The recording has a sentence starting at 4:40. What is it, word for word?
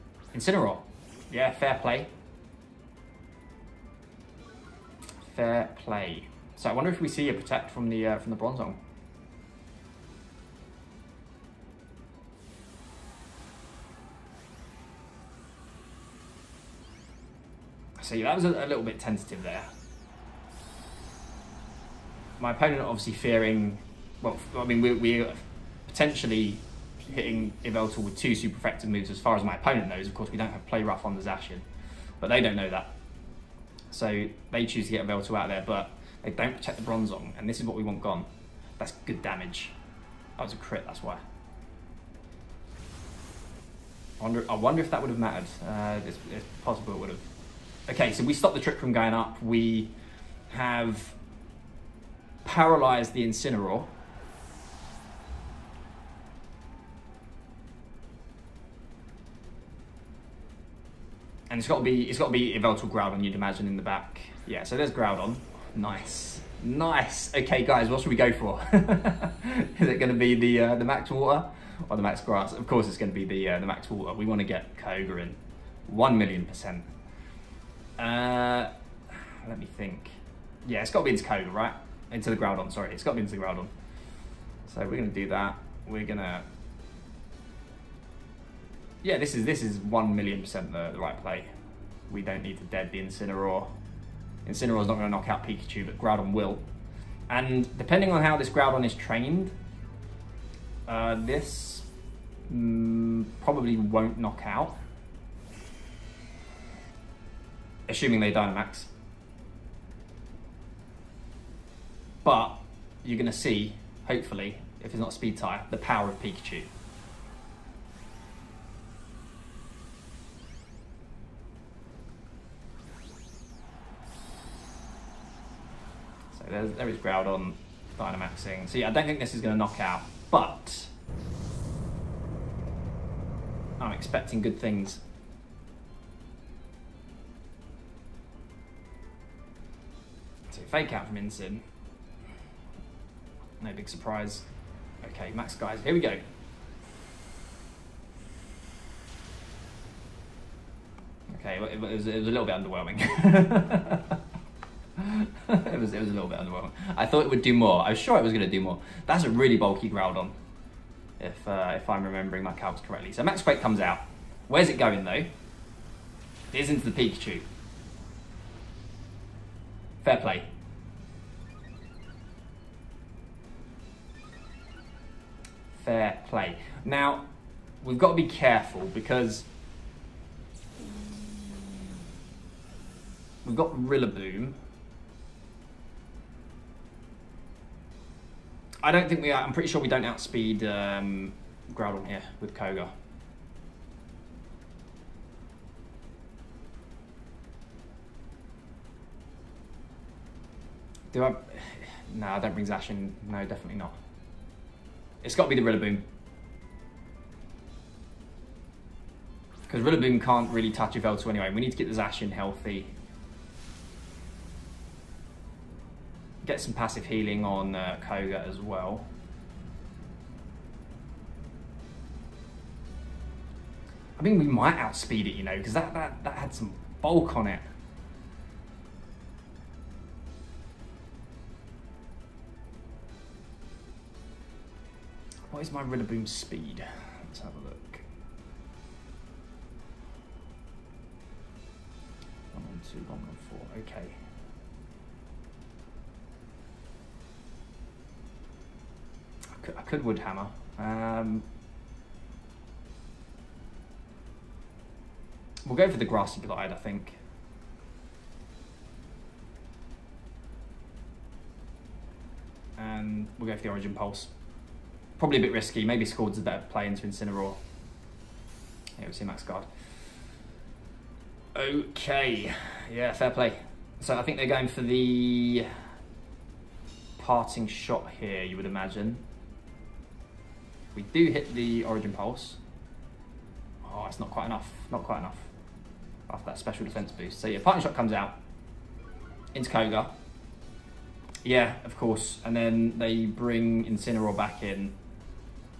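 We do hit the Origin Pulse.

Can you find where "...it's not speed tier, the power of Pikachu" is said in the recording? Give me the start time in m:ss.
1:54.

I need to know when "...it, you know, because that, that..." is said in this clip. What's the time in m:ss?
3:45.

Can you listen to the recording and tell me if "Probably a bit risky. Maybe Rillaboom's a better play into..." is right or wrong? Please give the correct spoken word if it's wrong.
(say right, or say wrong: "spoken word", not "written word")
wrong: "Scald", not "Rillaboom".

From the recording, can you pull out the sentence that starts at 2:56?
Now, we've got to be careful because we've got Rillaboom.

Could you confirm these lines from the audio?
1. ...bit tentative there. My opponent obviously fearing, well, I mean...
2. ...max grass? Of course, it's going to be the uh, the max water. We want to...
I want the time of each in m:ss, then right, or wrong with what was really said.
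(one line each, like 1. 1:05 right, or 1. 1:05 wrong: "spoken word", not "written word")
1. 0:18 right
2. 1:12 right.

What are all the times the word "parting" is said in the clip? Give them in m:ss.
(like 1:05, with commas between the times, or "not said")
4:37, 4:47.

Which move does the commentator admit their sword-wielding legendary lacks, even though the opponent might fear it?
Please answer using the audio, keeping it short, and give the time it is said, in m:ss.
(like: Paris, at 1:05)
Play Rough, at 0:30.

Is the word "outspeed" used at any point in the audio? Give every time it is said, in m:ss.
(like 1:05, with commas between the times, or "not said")
3:10, 3:44.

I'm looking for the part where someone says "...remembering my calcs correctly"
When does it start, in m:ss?
2:42.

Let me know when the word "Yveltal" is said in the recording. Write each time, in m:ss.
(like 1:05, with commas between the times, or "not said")
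0:27, 0:35, 1:02, 3:30.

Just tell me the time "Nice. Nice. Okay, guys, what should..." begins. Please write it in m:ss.
1:05.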